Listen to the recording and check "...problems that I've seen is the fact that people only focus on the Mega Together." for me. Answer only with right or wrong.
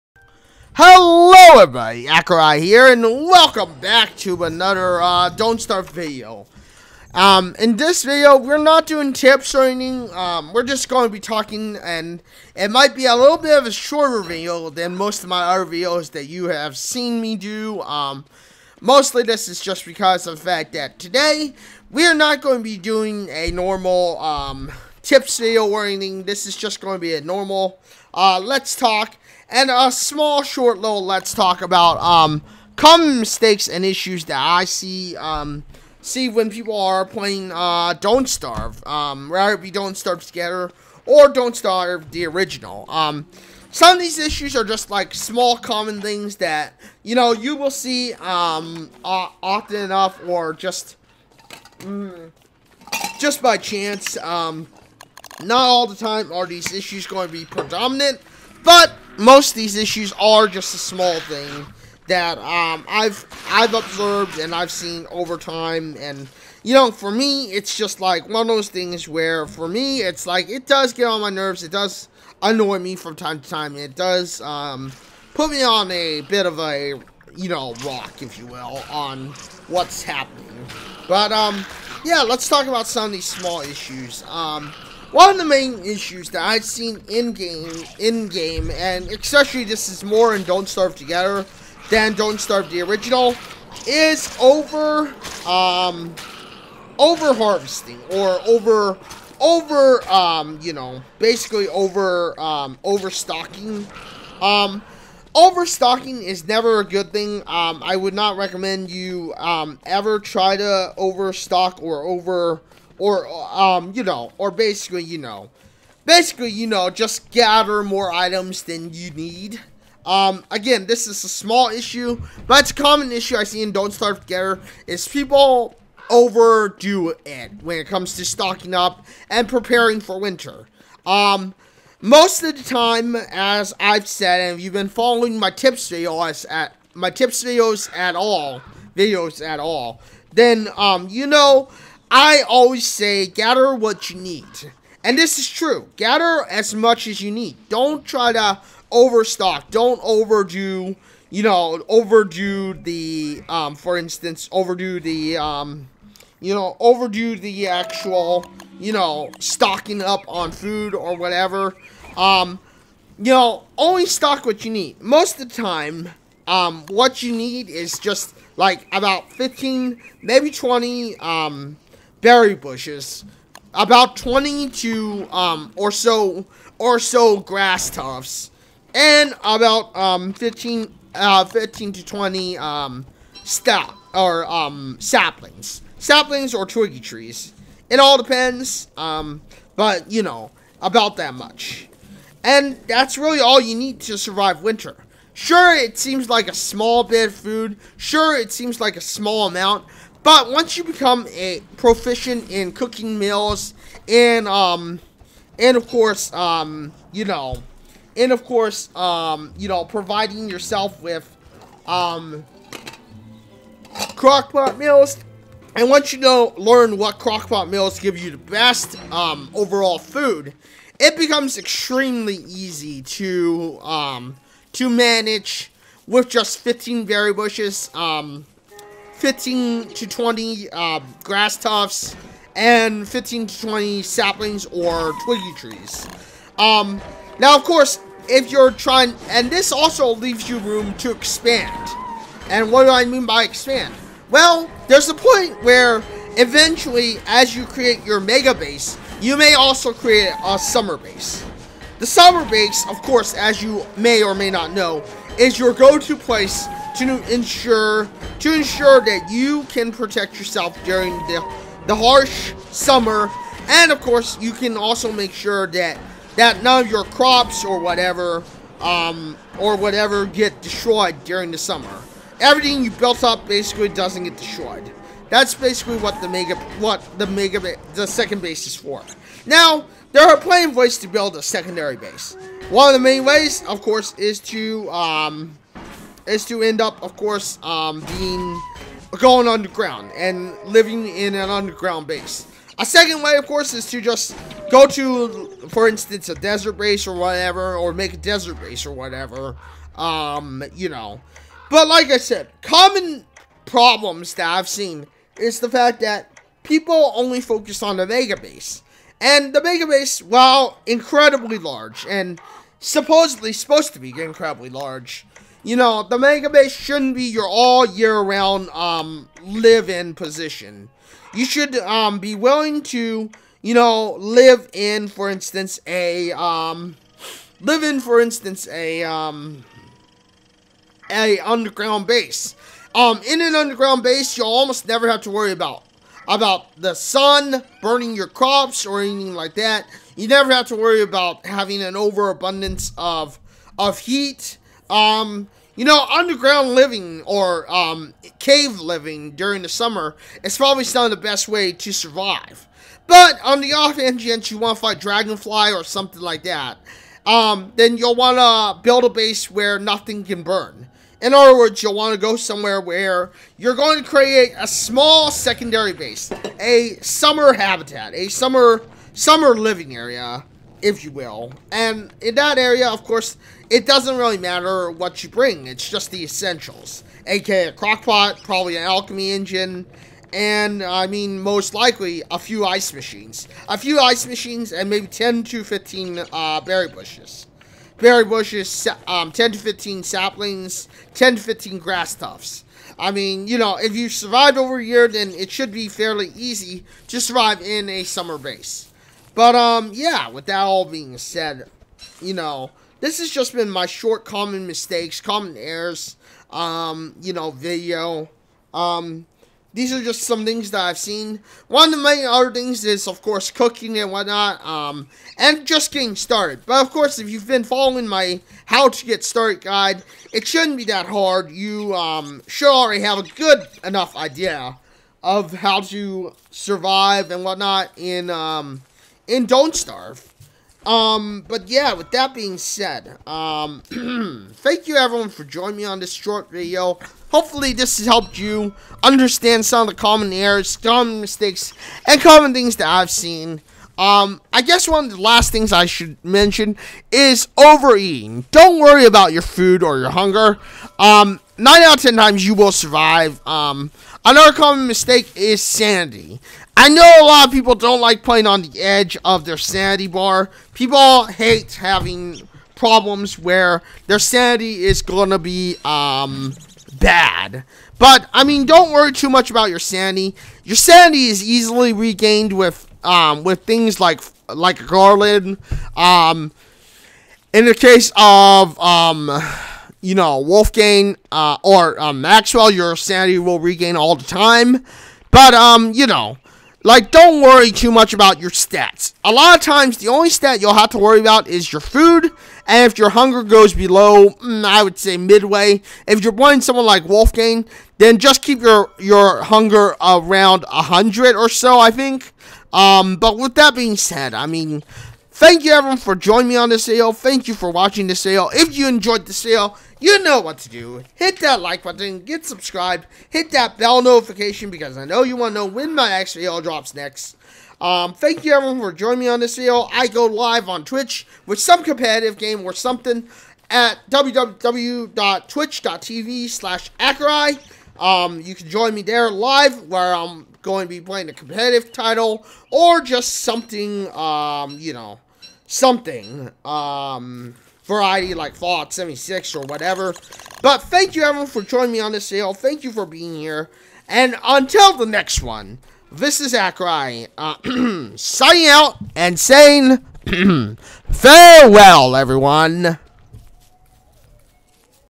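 wrong.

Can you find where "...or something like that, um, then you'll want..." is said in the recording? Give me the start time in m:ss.
5:55.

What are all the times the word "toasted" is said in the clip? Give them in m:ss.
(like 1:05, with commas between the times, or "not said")
not said.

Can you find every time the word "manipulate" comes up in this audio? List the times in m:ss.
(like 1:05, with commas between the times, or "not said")
not said.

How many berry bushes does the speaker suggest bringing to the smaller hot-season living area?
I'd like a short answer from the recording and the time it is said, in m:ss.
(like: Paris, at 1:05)
10 to 15, at 6:25.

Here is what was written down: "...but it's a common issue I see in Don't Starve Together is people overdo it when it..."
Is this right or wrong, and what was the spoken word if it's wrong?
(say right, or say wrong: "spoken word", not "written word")
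right.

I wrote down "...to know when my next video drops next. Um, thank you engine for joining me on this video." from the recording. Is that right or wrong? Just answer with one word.
wrong.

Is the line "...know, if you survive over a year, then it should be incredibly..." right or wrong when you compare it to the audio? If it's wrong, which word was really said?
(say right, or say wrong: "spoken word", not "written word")
wrong: "fairly", not "incredibly".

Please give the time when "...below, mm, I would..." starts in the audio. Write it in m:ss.
8:13.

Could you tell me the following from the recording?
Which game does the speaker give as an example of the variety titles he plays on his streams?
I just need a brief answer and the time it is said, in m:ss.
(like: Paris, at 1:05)
Fallout 76, at 8:58.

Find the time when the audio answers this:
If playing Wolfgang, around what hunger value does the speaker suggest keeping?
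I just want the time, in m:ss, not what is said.
8:20.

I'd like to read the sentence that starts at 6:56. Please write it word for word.
But, of course, if you've been following my how to get started guide, it shouldn't be that hard.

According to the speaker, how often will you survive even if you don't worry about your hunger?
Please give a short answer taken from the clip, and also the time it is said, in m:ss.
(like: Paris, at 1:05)
9 out of 10 times, at 7:31.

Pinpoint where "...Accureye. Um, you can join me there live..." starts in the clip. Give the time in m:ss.
8:46.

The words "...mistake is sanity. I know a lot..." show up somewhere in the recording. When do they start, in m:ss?
7:34.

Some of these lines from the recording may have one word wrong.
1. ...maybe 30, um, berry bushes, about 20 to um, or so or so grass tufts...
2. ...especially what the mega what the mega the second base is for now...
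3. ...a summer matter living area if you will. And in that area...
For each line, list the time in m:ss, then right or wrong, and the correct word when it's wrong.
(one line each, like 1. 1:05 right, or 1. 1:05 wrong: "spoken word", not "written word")
1. 2:50 wrong: "20", not "30"
2. 4:35 wrong: "basically", not "especially"
3. 6:08 wrong: "summer", not "matter".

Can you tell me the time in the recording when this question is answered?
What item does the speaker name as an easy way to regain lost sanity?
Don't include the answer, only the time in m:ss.
7:54.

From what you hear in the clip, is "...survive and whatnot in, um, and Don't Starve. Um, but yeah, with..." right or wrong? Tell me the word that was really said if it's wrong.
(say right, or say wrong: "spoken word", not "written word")
right.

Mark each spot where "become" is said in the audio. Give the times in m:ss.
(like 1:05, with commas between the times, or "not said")
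3:20, 3:41.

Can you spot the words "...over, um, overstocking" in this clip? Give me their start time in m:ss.
1:41.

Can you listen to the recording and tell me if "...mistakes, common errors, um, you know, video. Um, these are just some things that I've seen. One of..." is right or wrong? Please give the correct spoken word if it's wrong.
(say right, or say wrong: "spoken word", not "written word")
right.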